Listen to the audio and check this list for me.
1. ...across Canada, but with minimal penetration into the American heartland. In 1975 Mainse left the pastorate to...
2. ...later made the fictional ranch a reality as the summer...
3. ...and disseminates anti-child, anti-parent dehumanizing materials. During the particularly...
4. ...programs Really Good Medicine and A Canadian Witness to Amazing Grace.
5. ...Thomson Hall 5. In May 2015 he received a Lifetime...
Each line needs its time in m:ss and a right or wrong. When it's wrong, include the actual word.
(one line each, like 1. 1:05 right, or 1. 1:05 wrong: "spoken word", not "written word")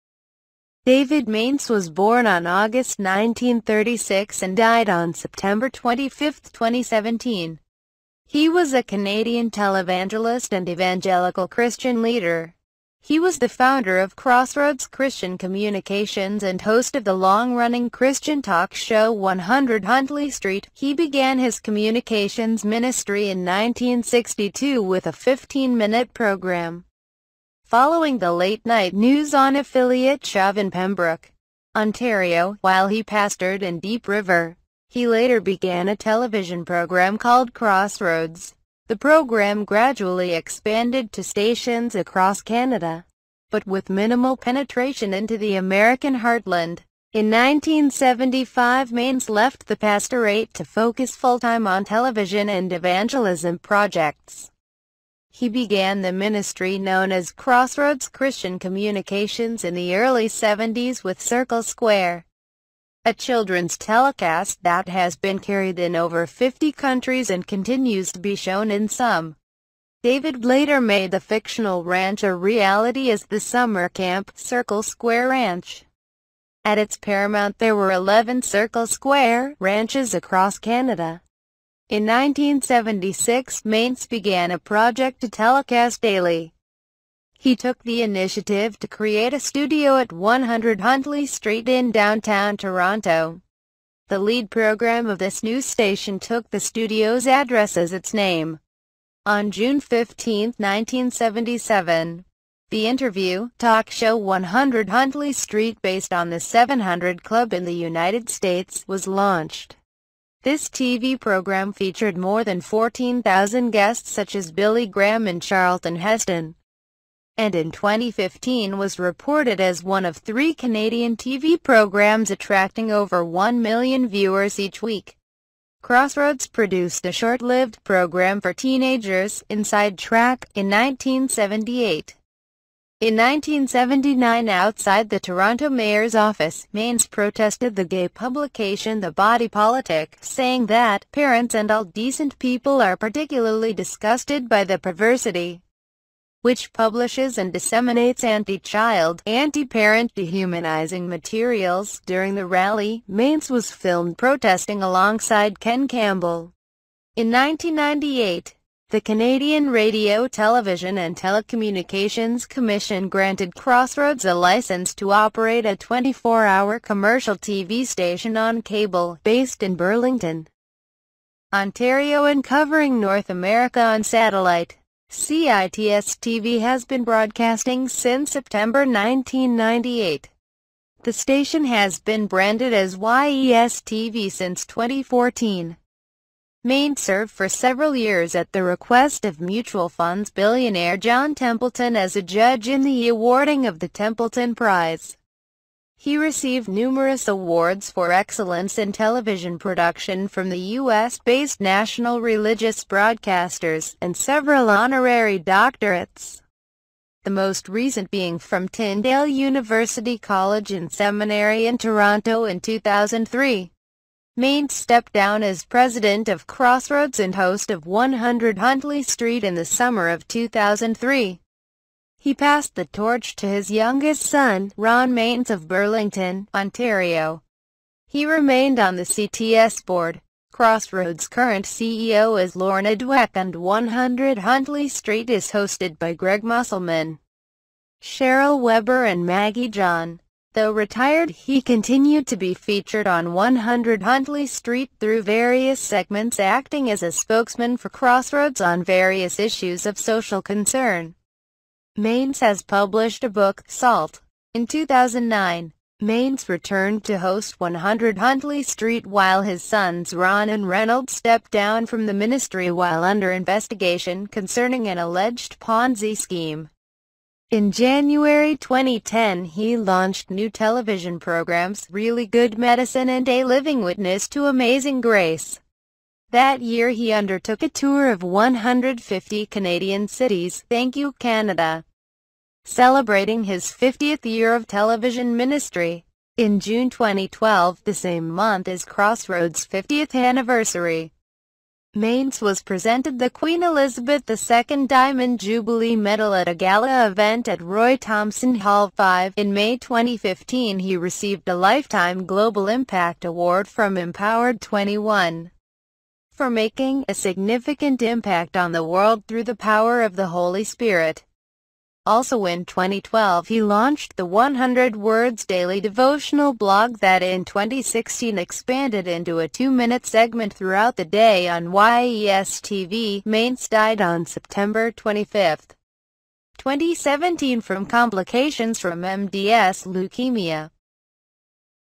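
1. 0:41 right
2. 1:10 right
3. 2:27 wrong: "rally", not "particularly"
4. 4:31 wrong: "Living", not "Canadian"
5. 4:57 right.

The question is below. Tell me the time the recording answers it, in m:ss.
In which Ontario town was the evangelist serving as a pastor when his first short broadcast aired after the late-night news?
0:33.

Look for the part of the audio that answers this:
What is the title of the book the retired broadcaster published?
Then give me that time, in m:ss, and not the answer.
4:13.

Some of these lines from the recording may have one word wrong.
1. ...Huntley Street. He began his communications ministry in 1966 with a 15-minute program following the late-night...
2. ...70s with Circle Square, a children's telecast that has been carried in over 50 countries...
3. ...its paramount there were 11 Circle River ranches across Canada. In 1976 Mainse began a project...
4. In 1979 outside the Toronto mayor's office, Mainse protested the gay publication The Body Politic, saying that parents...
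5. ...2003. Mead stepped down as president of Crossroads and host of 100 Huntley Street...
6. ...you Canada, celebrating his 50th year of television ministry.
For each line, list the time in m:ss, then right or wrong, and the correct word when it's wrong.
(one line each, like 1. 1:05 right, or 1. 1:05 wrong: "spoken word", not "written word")
1. 0:19 wrong: "1962", not "1966"
2. 1:00 right
3. 1:16 wrong: "Square", not "River"
4. 2:13 right
5. 3:32 right
6. 4:40 right.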